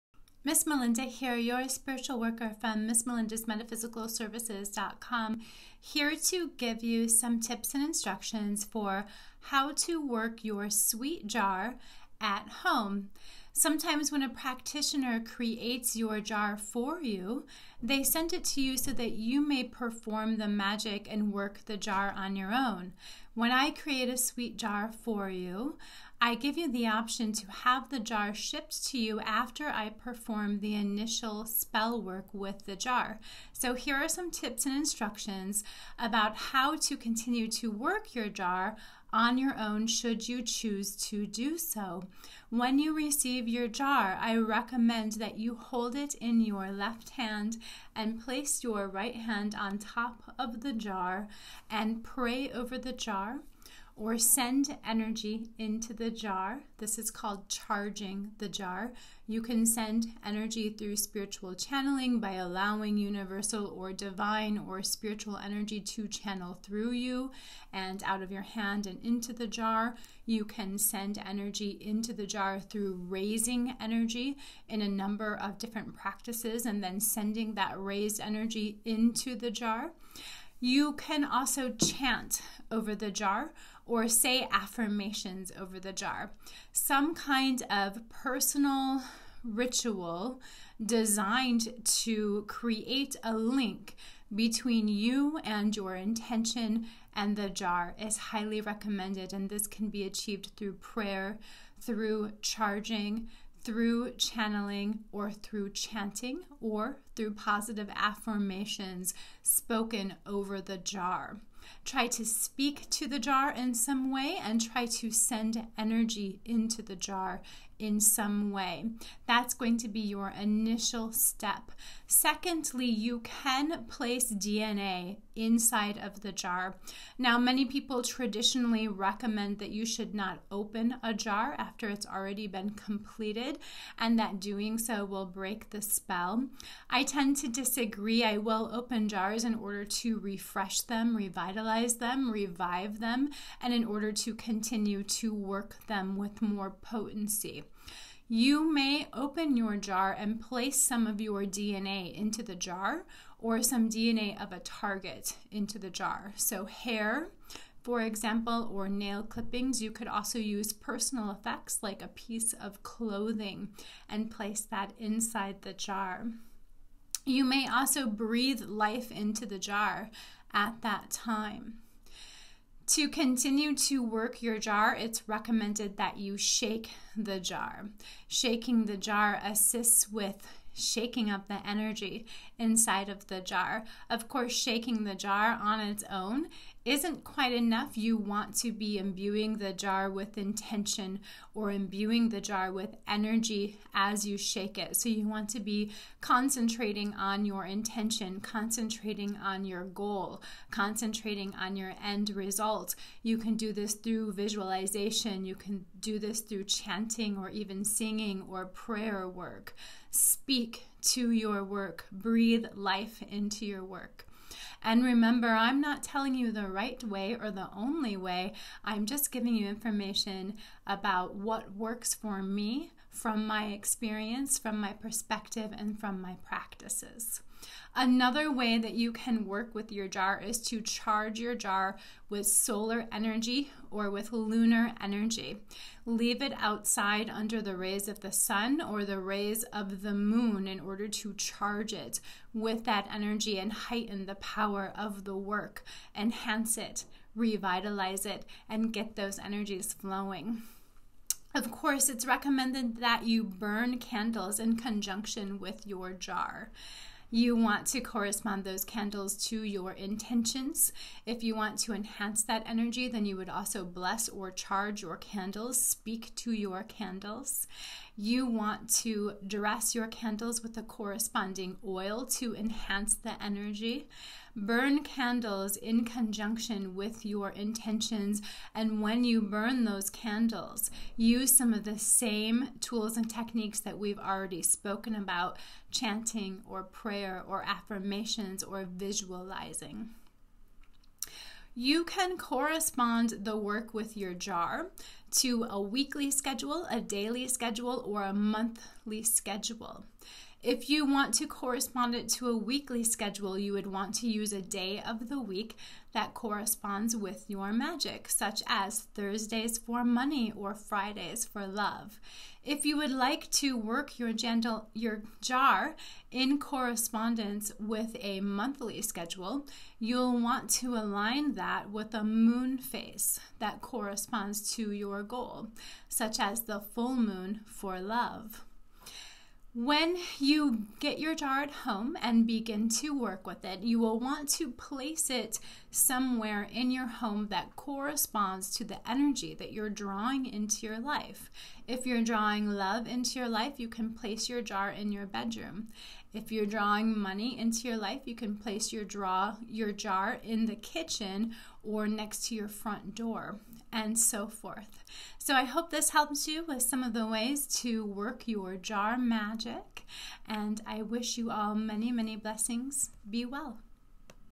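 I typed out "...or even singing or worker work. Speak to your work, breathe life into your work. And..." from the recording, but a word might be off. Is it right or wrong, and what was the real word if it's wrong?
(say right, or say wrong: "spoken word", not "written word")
wrong: "prayer", not "worker".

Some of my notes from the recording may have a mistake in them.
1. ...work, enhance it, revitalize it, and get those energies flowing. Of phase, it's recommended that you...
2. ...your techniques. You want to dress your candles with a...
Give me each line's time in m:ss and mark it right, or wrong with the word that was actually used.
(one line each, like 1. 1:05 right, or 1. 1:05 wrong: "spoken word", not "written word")
1. 4:05 wrong: "course", not "phase"
2. 4:26 wrong: "candles", not "techniques".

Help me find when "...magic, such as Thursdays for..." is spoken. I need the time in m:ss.
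5:07.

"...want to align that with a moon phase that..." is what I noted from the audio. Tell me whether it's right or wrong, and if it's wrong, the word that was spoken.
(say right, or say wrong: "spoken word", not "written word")
right.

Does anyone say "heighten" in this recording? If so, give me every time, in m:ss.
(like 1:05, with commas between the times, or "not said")
4:03.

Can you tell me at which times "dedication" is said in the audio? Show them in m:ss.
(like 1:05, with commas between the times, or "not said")
not said.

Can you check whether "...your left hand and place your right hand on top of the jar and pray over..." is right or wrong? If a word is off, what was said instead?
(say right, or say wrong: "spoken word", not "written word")
right.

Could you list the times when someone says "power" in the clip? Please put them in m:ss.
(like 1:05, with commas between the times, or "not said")
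4:04.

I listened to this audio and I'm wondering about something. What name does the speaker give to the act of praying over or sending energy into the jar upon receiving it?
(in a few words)
Charging the jar.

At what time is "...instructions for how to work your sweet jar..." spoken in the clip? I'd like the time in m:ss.
0:07.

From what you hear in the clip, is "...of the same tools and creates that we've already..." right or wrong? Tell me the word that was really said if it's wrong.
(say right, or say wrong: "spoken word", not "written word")
wrong: "techniques", not "creates".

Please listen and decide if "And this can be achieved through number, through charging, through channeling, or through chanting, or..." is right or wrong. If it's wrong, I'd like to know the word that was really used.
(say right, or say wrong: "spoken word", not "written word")
wrong: "prayer", not "number".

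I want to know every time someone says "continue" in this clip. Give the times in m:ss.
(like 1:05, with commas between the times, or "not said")
0:36, 2:24, 2:53.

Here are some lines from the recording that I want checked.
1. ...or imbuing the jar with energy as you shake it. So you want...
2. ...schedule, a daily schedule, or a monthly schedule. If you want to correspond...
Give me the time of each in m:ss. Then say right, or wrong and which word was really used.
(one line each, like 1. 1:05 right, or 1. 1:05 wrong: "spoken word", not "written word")
1. 3:11 right
2. 4:56 right.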